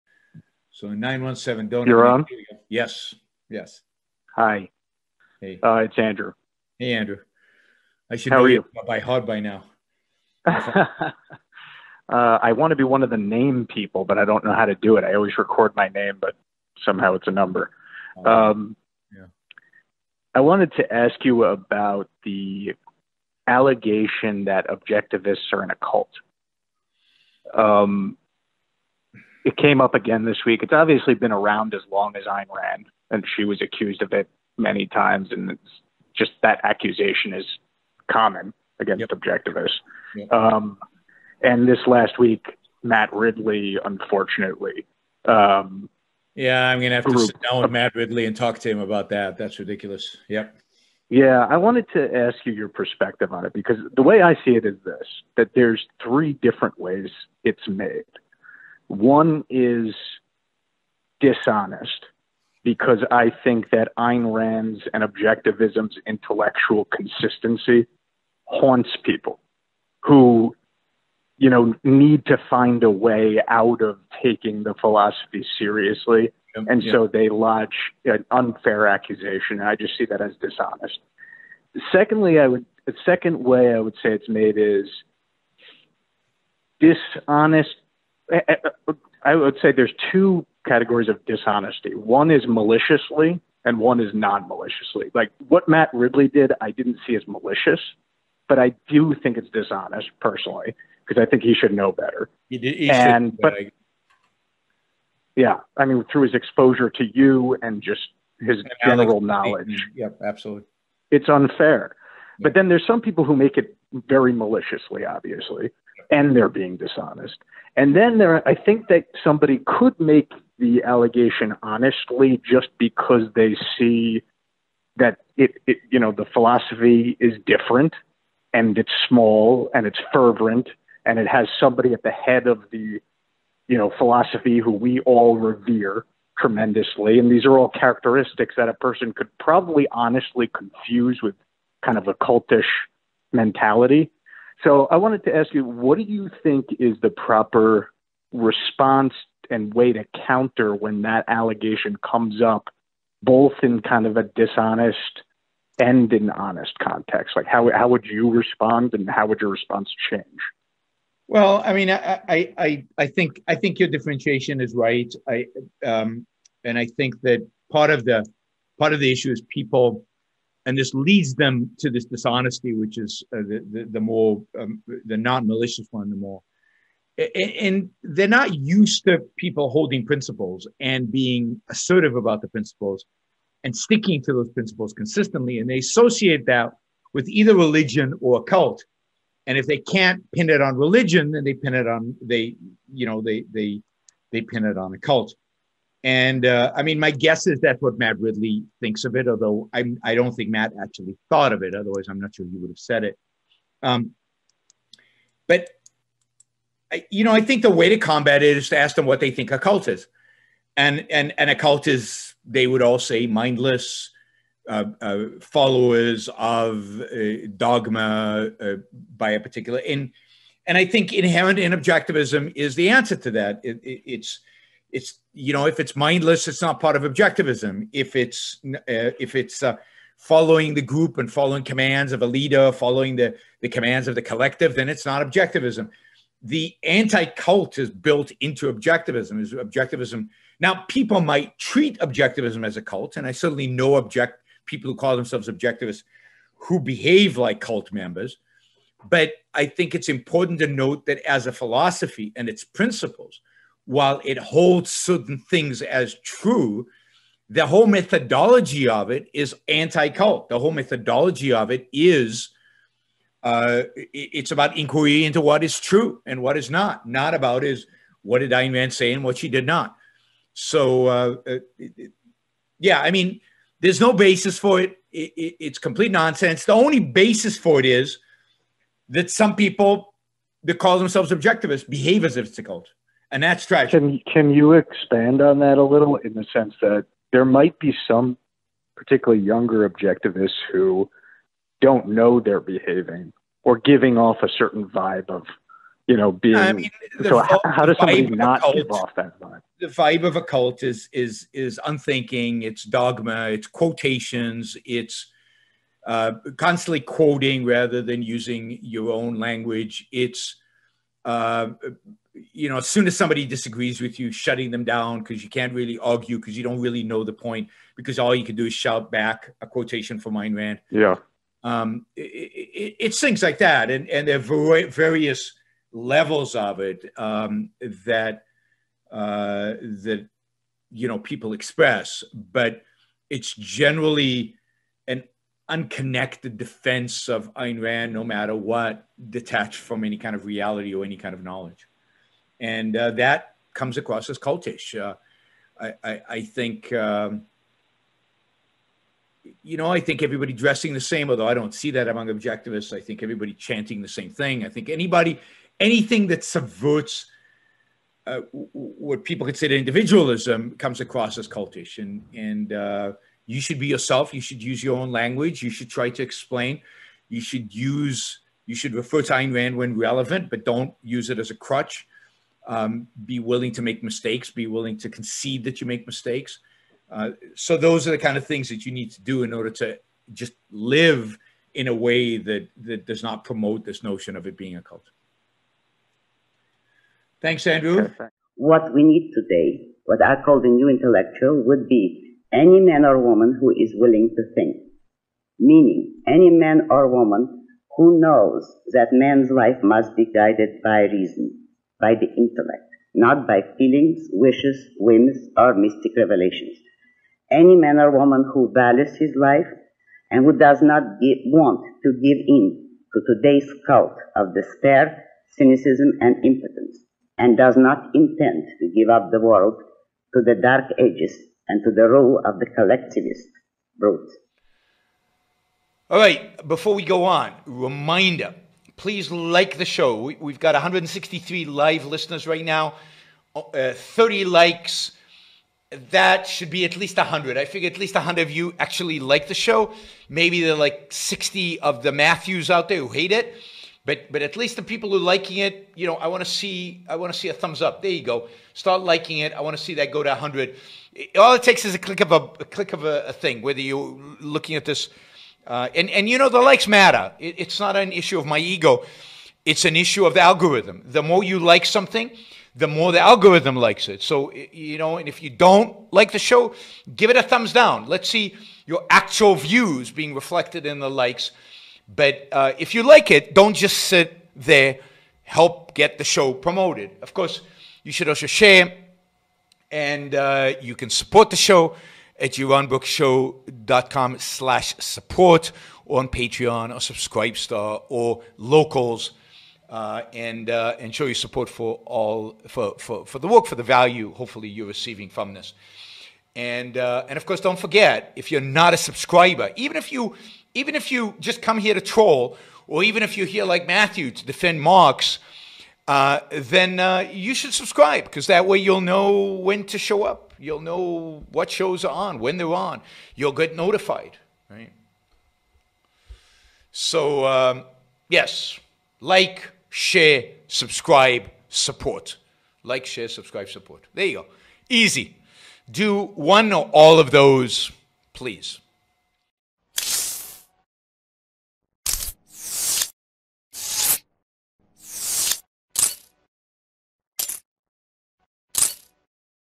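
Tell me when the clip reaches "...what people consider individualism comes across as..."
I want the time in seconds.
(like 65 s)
358 s.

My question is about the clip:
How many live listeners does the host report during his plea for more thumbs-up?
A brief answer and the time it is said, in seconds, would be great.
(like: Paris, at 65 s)
163, at 430 s.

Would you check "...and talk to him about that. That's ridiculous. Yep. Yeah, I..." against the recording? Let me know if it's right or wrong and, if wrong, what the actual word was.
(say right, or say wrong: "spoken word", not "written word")
right.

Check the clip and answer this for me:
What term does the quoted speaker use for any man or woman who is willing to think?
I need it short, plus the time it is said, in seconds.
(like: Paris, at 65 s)
the new intellectual, at 390 s.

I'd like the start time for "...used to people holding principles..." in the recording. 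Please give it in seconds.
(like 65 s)
178 s.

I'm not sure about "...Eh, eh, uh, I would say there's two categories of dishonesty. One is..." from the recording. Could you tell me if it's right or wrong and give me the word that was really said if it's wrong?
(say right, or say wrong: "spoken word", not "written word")
right.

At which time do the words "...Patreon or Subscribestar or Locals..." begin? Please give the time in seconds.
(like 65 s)
486 s.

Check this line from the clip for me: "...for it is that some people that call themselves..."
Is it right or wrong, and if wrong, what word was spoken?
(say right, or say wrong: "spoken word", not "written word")
right.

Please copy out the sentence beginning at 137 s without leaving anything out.
And these are all characteristics that a person could probably honestly confuse with kind of a cultish mentality.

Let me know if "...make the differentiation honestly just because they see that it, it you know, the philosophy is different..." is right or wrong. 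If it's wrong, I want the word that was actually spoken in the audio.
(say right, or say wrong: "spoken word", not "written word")
wrong: "allegation", not "differentiation".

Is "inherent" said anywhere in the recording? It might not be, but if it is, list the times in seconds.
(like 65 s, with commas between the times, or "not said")
221 s.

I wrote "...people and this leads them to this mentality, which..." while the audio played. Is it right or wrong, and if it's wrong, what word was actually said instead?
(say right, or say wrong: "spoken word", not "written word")
wrong: "dishonesty", not "mentality".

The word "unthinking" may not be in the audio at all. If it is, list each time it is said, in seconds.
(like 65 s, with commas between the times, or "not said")
301 s.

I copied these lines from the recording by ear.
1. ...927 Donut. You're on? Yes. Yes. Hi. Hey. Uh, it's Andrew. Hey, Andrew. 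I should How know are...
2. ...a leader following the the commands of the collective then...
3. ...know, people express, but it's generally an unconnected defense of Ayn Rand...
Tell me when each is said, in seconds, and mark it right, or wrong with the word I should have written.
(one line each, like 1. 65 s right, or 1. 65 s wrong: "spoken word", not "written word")
1. 0 s wrong: "917", not "927"
2. 232 s right
3. 331 s right.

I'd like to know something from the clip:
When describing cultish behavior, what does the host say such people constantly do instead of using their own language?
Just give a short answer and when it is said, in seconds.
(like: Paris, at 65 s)
quoting, at 306 s.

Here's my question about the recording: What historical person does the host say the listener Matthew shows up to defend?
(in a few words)
Marx.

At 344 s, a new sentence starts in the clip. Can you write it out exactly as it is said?
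Uh, I, I, I, think, um, you know, I think everybody dressing the same, although I don't see that among objectivists.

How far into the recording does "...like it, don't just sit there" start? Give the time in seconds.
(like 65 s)
473 s.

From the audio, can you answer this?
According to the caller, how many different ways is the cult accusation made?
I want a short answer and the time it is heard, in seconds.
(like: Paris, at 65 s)
3, at 56 s.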